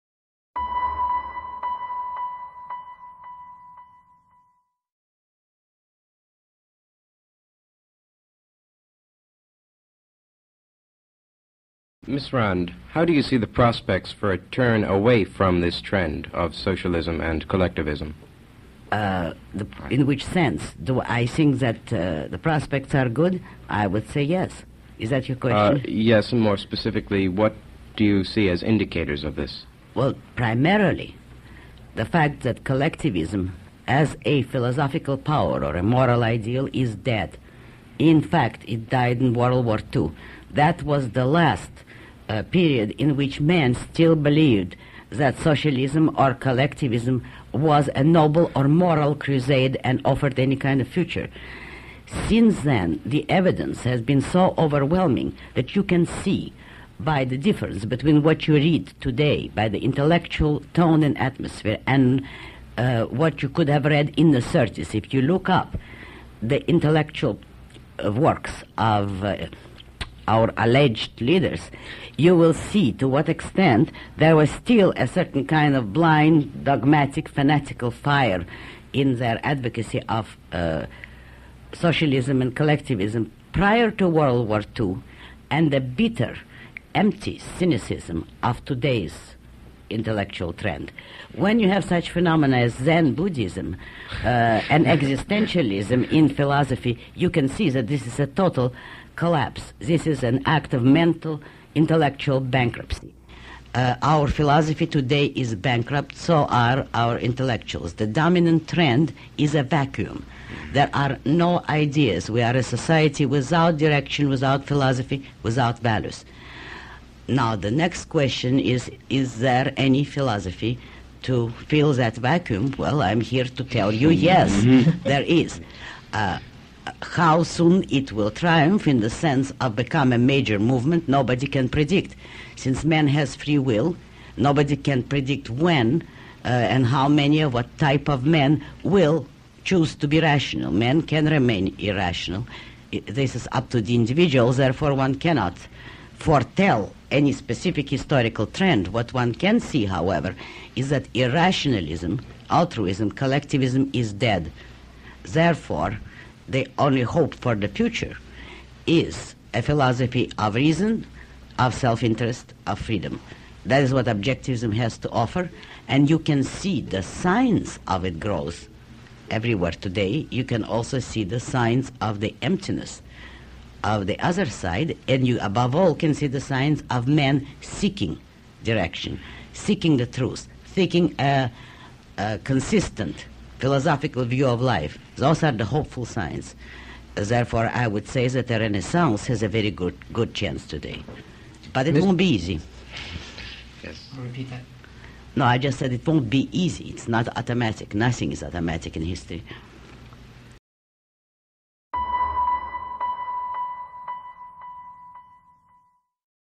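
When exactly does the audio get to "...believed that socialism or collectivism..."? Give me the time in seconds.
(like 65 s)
44 s.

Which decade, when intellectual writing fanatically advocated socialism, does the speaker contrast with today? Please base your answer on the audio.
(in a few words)
the 30s.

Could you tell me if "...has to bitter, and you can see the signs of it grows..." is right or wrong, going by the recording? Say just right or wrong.
wrong.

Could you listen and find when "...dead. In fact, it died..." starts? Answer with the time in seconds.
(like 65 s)
36 s.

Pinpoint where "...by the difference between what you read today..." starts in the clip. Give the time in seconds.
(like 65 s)
56 s.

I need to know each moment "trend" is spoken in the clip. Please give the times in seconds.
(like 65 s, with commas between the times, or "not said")
15 s, 90 s, 108 s, 148 s.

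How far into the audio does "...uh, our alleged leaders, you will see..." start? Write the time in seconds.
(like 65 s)
69 s.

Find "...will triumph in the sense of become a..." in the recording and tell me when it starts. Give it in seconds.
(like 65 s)
128 s.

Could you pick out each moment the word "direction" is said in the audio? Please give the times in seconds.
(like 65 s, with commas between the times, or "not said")
113 s, 178 s.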